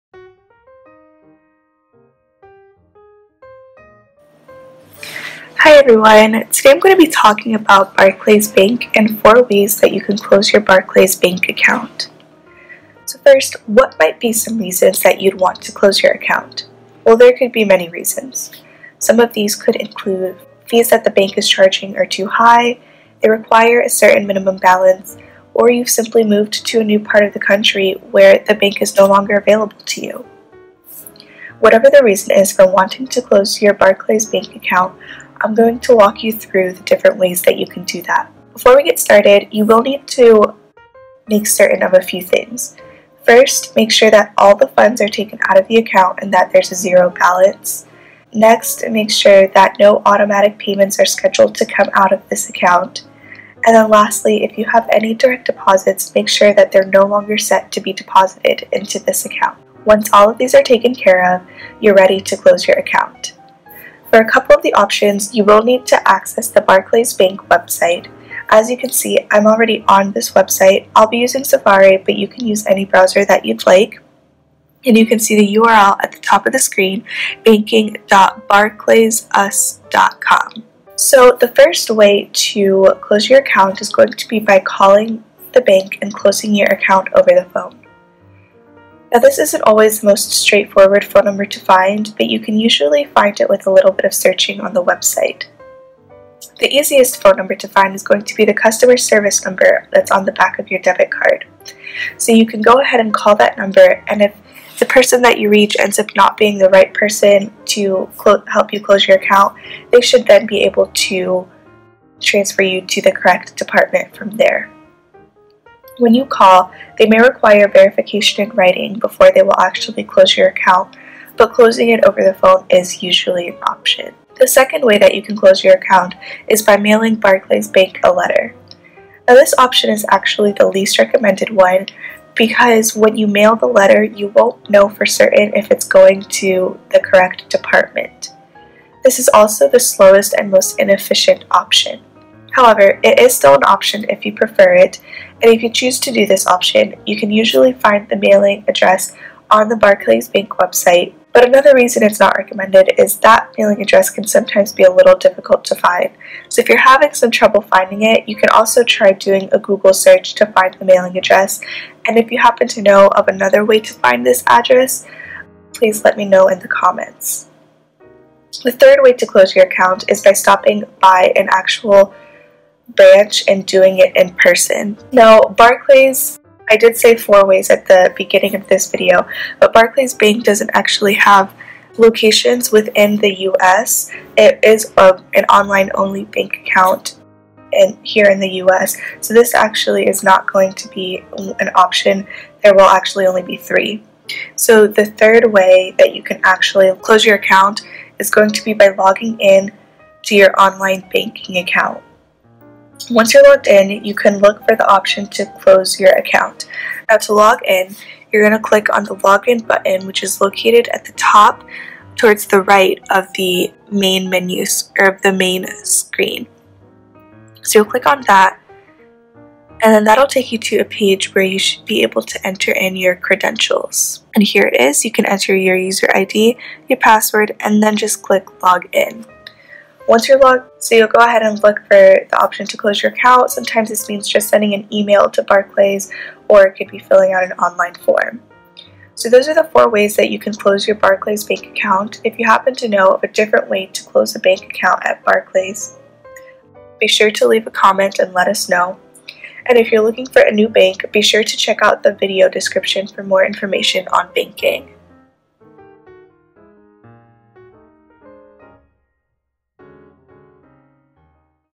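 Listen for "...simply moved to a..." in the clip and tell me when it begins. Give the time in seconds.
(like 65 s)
25 s.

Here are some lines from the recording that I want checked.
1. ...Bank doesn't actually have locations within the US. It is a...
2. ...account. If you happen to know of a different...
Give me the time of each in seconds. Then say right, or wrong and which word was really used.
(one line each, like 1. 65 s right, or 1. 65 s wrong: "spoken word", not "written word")
1. 180 s right
2. 241 s right.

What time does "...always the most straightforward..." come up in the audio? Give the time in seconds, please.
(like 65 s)
89 s.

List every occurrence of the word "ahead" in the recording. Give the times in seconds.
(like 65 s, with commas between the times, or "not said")
102 s, 231 s.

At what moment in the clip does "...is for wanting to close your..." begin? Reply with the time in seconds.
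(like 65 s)
32 s.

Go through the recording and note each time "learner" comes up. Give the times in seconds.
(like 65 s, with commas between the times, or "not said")
not said.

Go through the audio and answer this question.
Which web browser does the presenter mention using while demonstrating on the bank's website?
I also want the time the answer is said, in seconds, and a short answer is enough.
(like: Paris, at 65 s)
Safari, at 71 s.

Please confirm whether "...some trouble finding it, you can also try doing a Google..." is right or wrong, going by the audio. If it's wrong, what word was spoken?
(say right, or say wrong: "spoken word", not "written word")
right.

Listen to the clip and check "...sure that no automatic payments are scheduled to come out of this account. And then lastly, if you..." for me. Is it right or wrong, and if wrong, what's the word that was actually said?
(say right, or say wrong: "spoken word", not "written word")
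right.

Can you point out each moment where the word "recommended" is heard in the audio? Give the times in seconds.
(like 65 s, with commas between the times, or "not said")
130 s, 152 s.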